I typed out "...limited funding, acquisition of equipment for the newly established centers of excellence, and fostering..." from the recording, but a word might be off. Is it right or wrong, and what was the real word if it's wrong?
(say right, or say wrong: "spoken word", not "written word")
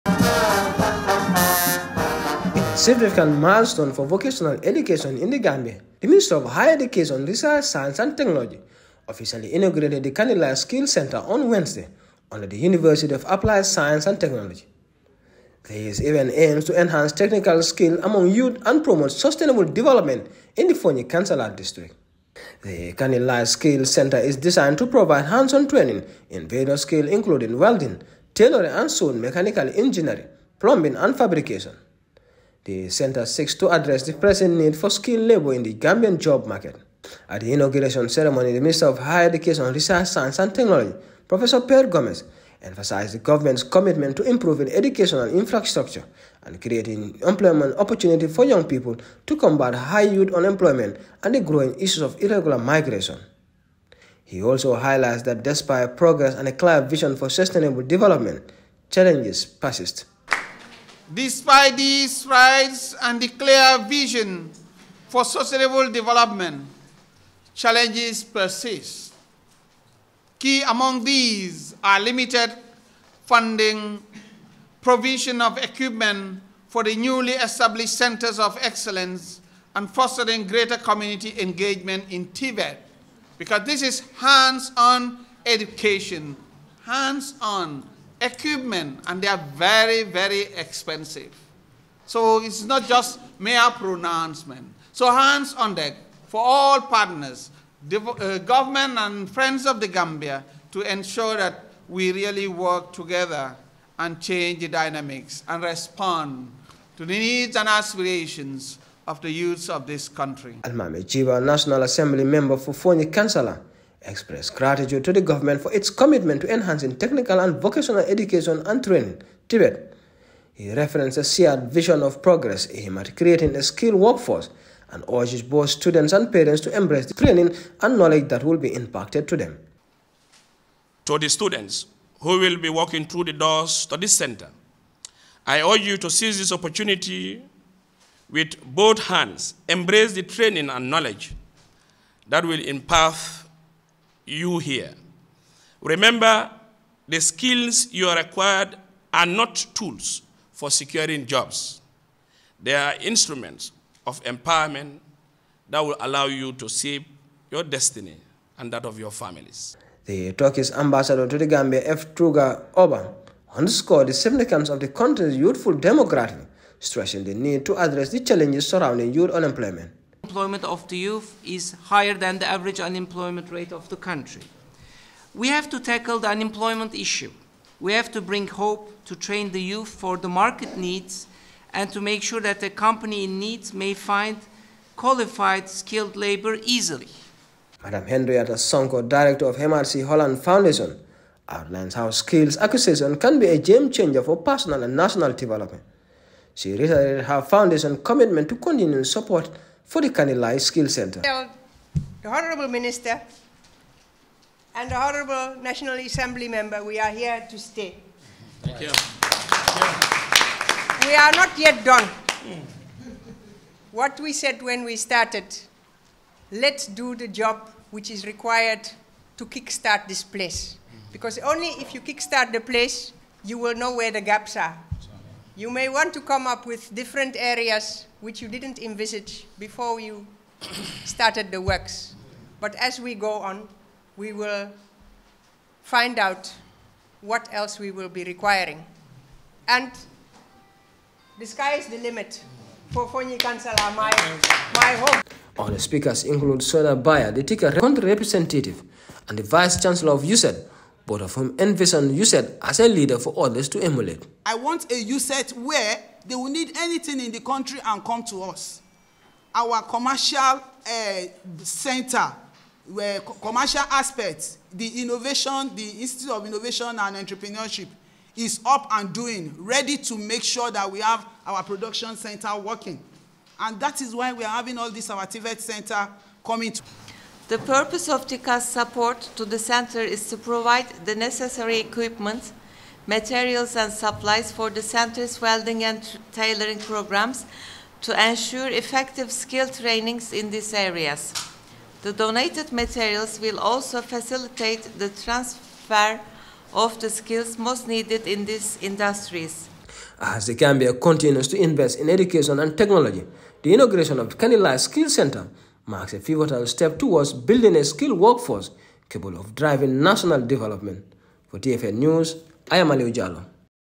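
wrong: "provision", not "acquisition".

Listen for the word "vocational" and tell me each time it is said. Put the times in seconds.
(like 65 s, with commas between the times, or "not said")
4 s, 117 s.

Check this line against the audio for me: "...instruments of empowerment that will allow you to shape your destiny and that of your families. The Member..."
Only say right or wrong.
wrong.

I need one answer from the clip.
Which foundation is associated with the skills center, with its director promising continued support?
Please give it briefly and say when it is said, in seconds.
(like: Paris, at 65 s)
MRC Holland Foundation, at 189 s.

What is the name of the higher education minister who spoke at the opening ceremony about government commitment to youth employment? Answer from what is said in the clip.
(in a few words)
Pierre Gomez.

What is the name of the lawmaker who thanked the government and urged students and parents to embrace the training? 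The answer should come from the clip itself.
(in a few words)
Almameh Gibba.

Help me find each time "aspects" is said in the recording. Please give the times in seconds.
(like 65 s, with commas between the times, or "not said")
263 s.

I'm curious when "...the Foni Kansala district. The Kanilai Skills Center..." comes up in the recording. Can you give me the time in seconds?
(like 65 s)
20 s.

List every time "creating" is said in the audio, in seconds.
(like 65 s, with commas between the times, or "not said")
46 s, 123 s.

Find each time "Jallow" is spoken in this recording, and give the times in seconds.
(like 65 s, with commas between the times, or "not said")
313 s.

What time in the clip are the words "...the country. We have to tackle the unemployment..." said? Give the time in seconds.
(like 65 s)
173 s.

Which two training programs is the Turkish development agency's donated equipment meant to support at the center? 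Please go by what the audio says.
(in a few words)
welding and tailoring.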